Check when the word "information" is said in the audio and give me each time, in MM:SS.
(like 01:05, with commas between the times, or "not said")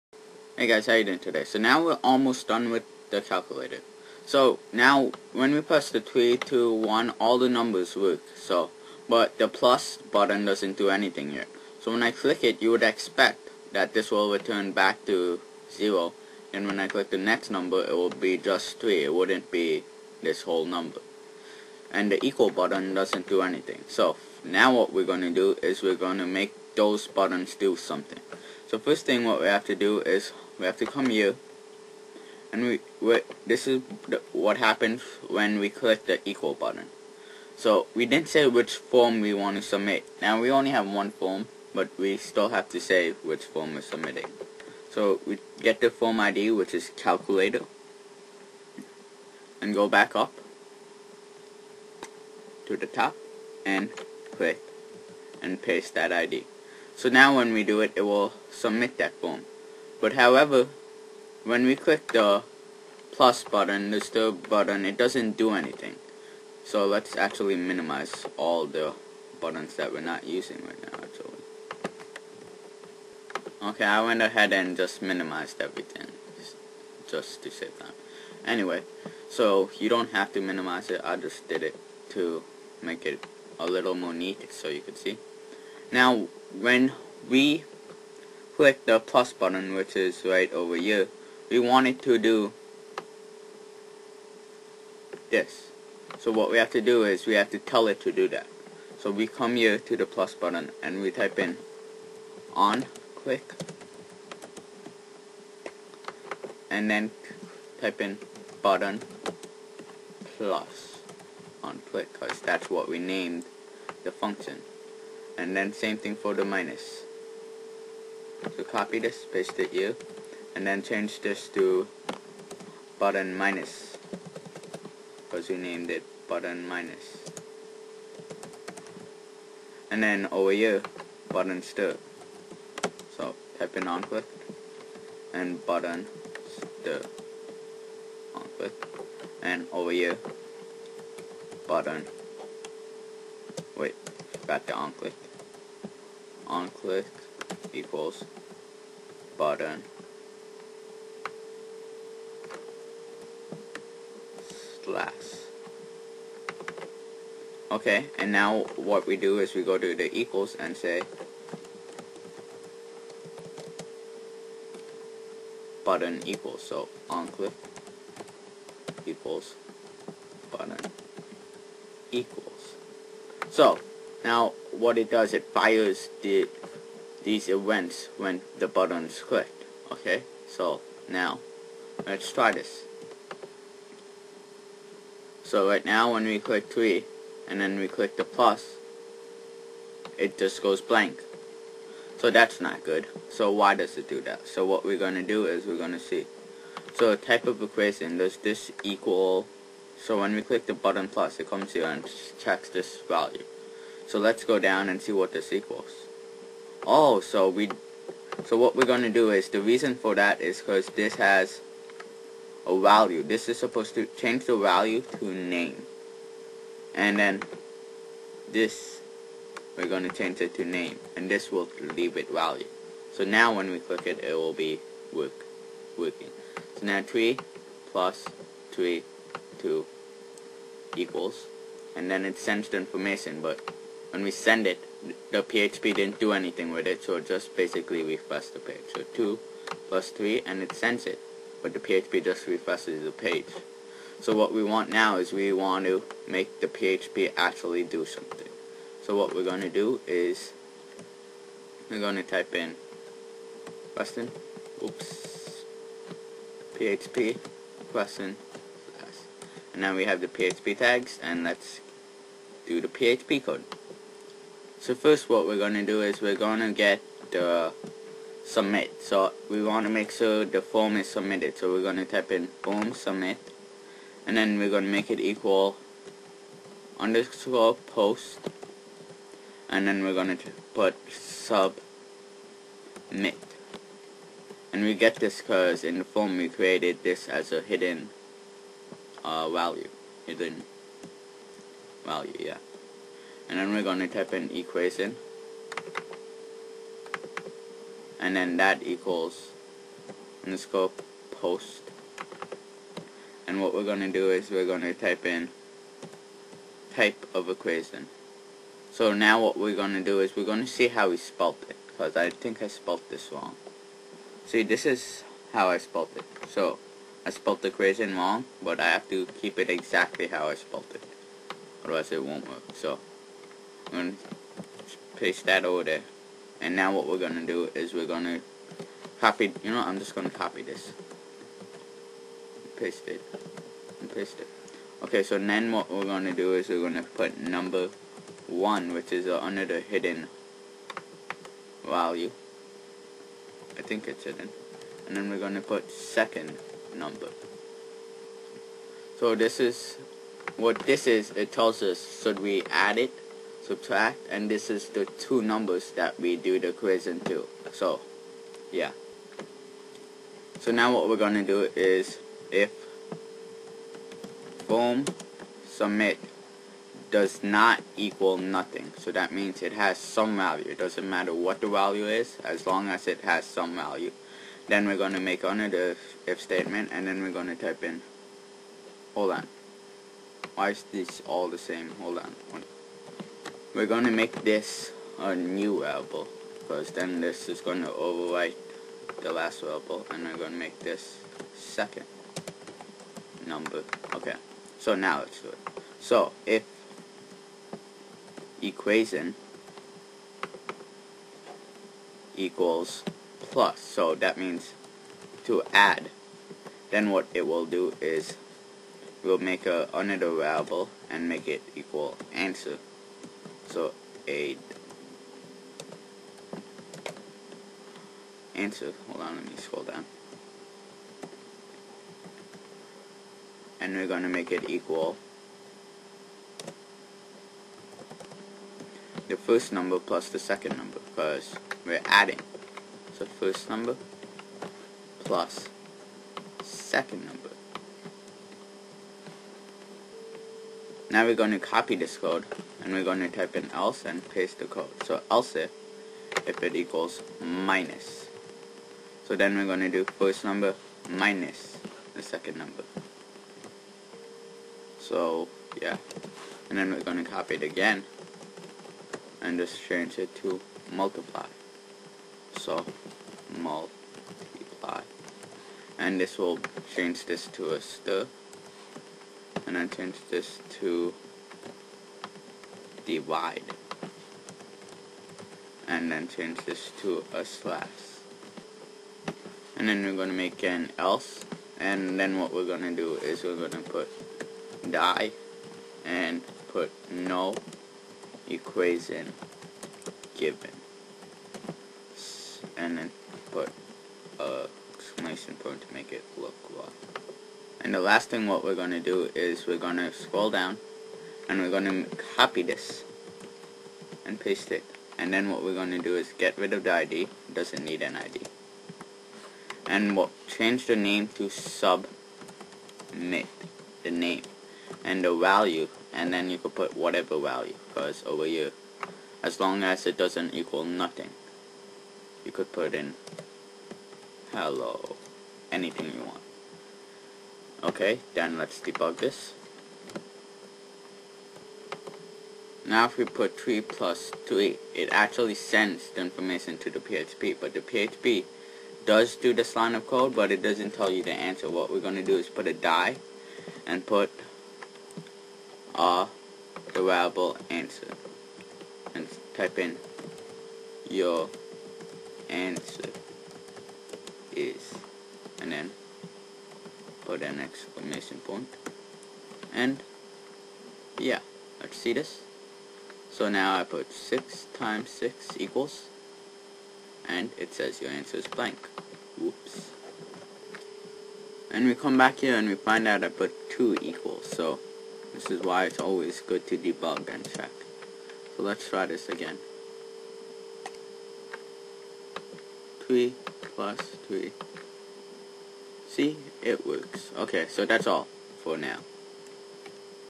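03:52, 08:56.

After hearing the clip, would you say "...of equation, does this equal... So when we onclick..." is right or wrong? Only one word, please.
wrong.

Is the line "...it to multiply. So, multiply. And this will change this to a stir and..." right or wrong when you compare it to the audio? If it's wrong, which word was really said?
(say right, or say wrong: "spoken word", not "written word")
right.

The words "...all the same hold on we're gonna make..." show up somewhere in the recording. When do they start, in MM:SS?
06:21.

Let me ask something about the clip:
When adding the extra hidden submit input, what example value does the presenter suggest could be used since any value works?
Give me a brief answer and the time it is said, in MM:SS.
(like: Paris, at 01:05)
hello, at 08:44.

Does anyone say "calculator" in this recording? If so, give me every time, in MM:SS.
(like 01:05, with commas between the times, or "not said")
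00:03, 00:46.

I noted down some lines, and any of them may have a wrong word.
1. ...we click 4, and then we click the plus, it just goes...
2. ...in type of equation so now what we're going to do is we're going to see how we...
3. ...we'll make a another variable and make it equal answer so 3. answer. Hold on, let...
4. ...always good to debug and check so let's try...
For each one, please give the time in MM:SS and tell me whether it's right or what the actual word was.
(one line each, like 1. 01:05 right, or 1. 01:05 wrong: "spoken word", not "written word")
1. 03:06 wrong: "3", not "4"
2. 05:05 right
3. 06:49 wrong: "8", not "3"
4. 09:35 right.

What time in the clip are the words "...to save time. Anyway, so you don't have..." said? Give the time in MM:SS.
01:17.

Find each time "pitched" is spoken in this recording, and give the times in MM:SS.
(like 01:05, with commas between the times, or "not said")
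not said.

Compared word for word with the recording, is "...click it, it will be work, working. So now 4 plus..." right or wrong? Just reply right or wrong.
wrong.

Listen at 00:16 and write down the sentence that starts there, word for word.
And when I click the next number, it will be just 3.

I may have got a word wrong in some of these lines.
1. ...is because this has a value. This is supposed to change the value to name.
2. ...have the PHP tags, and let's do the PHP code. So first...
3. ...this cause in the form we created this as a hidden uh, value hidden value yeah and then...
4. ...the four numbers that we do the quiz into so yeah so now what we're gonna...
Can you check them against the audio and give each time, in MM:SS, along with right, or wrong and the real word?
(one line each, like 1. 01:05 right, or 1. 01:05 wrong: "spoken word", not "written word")
1. 03:30 right
2. 04:20 right
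3. 04:45 right
4. 05:54 wrong: "two", not "four".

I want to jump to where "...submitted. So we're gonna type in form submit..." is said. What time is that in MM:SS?
04:31.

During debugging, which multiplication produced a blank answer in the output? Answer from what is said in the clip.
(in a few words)
6 times 6.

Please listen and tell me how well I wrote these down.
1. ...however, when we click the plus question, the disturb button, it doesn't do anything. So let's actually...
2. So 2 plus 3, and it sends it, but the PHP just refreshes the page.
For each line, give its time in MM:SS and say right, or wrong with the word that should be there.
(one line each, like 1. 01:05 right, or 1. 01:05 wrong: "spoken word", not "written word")
1. 01:00 wrong: "button", not "question"
2. 03:58 right.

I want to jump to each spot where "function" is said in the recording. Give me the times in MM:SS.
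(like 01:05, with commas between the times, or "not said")
01:54.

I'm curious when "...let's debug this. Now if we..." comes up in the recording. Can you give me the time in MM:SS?
08:48.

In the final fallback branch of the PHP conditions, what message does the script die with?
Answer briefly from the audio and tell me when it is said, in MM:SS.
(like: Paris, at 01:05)
no equation given, at 08:07.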